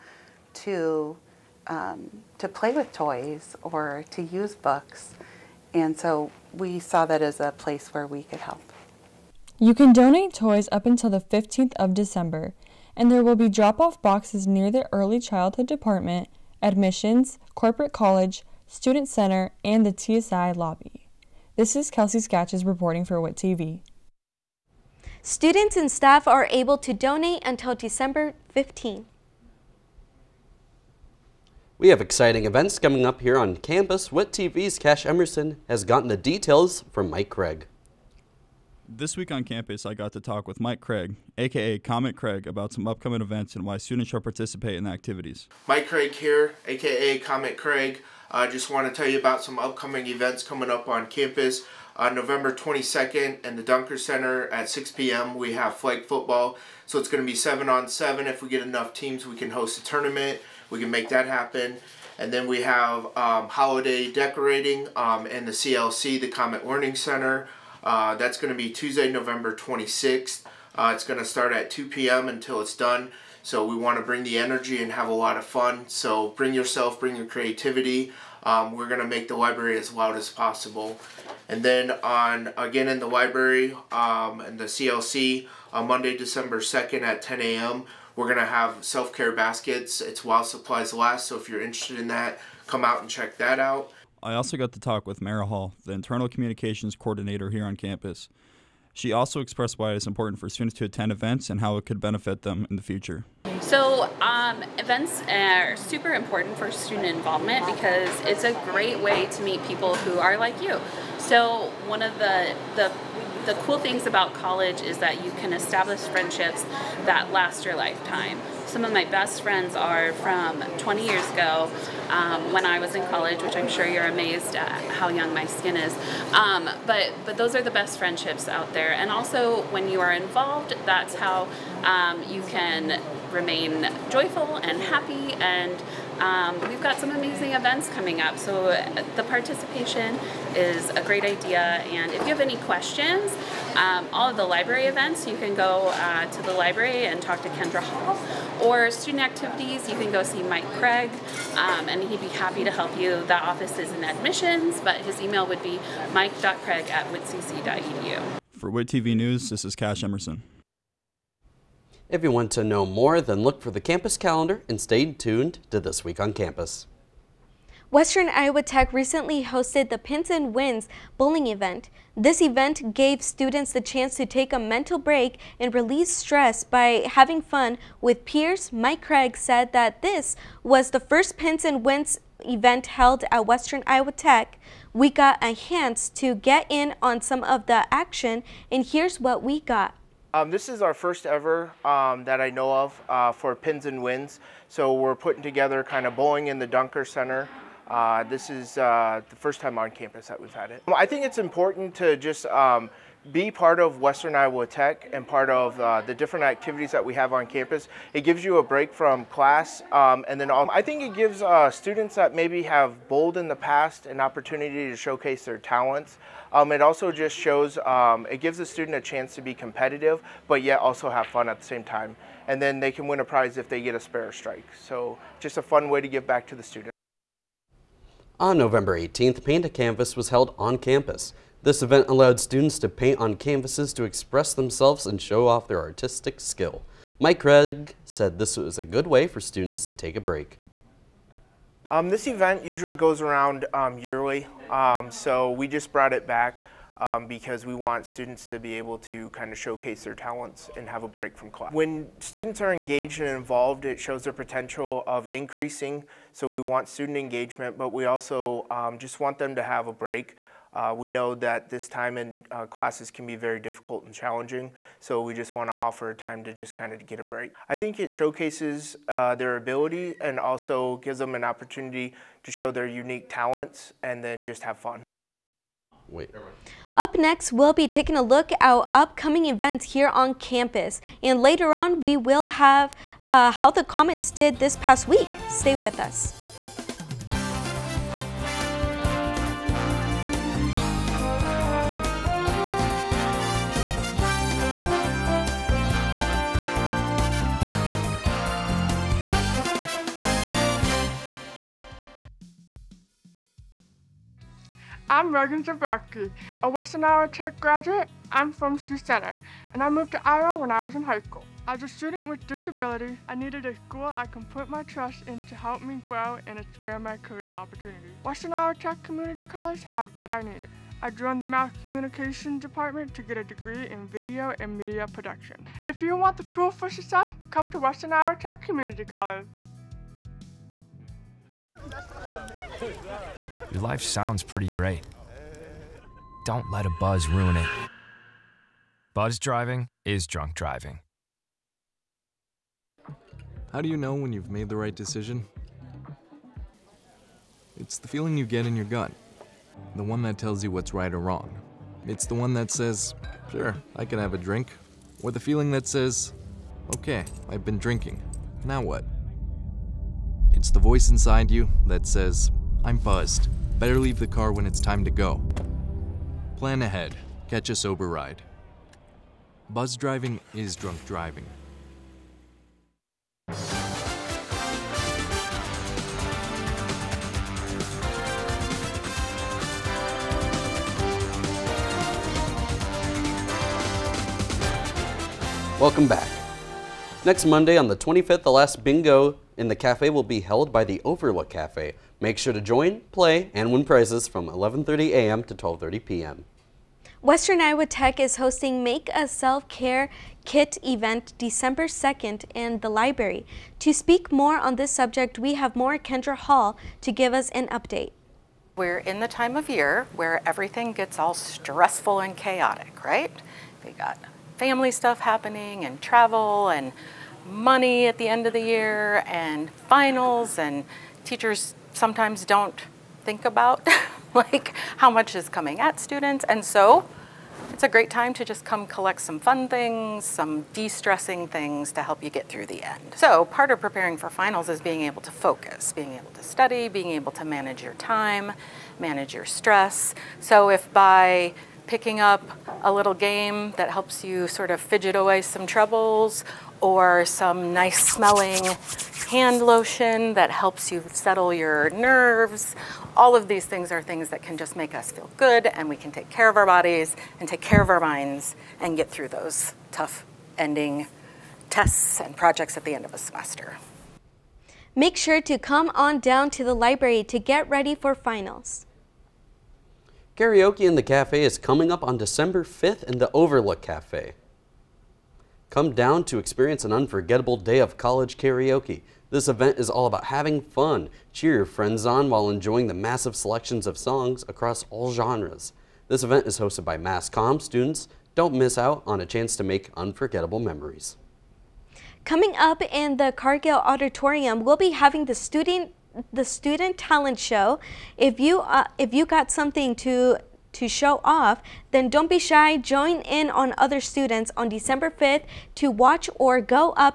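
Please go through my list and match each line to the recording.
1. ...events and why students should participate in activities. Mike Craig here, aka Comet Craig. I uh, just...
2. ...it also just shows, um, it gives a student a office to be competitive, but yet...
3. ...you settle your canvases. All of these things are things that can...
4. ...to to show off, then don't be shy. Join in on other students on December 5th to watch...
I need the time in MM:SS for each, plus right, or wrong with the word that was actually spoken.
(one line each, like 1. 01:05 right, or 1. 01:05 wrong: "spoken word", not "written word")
1. 00:43 right
2. 03:36 wrong: "chance", not "office"
3. 07:30 wrong: "nerves", not "canvases"
4. 08:19 right.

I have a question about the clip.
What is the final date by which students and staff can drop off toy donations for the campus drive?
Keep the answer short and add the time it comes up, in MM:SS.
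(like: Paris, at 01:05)
December 15, at 00:11.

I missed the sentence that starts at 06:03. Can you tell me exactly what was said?
Better leave the car when it's time to go.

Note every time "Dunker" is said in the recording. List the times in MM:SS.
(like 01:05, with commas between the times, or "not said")
00:53, 03:16.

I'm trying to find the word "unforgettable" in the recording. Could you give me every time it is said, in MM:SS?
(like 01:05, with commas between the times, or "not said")
07:56, 08:09.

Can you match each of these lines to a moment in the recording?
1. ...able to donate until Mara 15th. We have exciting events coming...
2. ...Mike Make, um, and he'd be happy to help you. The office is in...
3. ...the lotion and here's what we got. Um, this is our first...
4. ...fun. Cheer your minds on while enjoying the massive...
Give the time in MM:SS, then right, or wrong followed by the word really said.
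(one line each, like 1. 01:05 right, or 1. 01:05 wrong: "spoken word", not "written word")
1. 00:26 wrong: "December", not "Mara"
2. 02:30 wrong: "Craig", not "Make"
3. 03:07 wrong: "action", not "lotion"
4. 08:00 wrong: "friends", not "minds".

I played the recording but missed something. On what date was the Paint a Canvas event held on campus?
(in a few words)
November 18.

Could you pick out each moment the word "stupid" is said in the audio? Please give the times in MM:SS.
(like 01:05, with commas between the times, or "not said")
not said.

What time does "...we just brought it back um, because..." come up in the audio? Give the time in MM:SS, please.
04:05.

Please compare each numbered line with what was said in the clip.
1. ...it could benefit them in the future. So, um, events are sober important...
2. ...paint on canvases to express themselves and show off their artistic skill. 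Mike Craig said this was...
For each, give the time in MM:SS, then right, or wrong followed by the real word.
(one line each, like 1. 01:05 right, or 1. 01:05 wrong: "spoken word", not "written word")
1. 01:41 wrong: "super", not "sober"
2. 03:52 right.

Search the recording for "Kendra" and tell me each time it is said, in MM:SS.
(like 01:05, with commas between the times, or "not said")
02:27, 06:45.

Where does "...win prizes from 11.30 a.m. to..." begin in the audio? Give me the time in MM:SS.
06:33.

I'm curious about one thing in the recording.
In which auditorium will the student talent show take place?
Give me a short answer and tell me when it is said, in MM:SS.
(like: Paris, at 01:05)
Cargill Auditorium, at 08:13.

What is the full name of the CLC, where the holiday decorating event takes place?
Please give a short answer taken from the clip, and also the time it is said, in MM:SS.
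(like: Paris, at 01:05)
Comet Learning Center, at 01:06.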